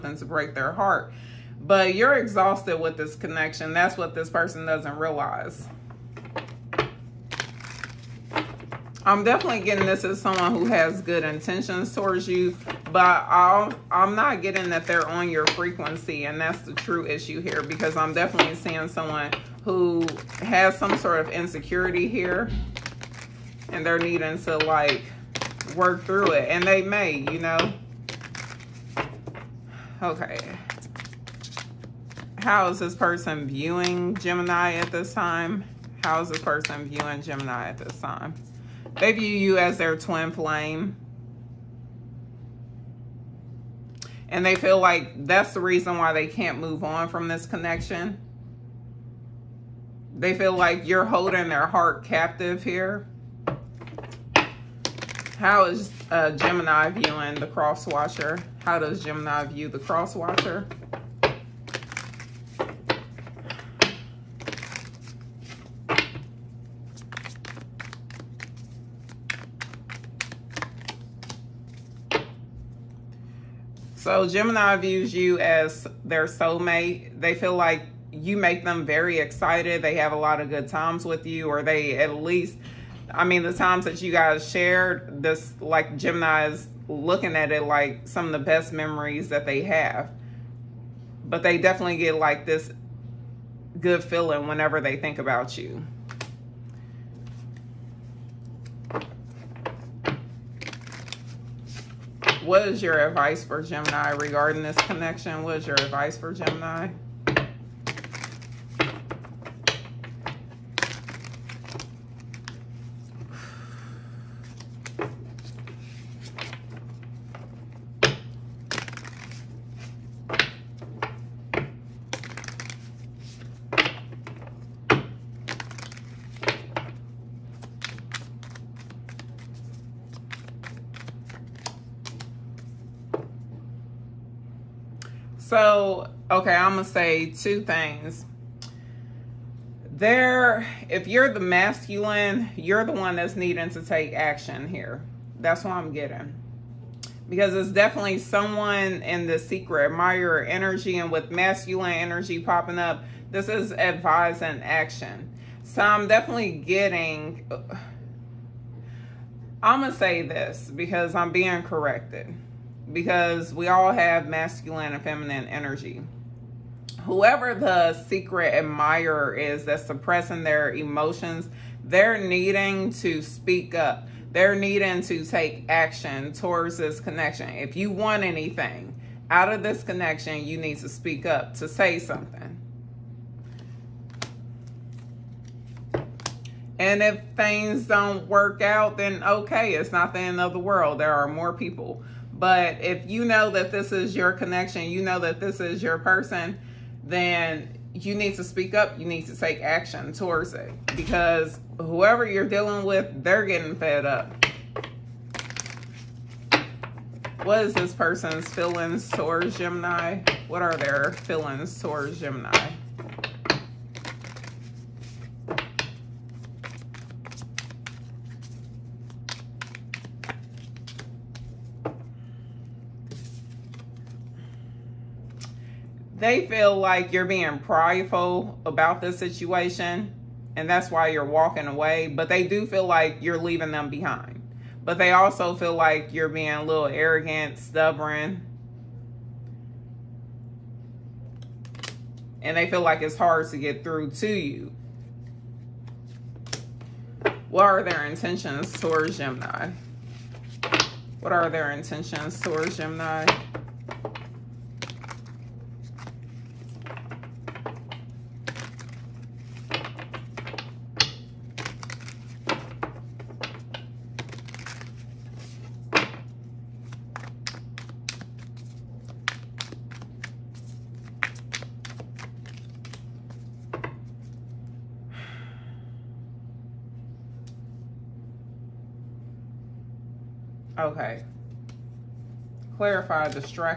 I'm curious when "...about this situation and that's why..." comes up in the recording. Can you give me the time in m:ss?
3:48.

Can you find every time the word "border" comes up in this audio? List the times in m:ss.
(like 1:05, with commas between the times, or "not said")
not said.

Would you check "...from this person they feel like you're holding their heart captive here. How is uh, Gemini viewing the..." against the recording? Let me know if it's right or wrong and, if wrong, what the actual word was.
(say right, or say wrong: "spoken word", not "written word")
wrong: "connection", not "person".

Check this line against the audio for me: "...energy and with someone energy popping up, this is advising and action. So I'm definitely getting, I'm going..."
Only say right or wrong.
wrong.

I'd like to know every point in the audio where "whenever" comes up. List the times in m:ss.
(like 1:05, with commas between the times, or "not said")
1:34.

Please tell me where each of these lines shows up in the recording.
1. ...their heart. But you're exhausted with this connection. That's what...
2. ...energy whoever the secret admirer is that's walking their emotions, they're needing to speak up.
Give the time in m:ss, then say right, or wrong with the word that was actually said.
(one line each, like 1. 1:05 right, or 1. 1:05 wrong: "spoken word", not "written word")
1. 0:00 right
2. 2:45 wrong: "suppressing", not "walking".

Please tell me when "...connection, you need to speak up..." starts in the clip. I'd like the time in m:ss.
2:59.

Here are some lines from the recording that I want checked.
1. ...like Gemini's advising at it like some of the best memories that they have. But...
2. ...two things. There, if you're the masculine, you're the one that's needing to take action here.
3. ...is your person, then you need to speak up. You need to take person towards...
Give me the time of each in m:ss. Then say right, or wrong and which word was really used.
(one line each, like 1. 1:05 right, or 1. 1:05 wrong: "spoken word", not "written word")
1. 1:25 wrong: "looking", not "advising"
2. 2:17 right
3. 3:15 wrong: "action", not "person".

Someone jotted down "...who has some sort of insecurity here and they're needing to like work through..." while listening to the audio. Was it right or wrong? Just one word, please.
right.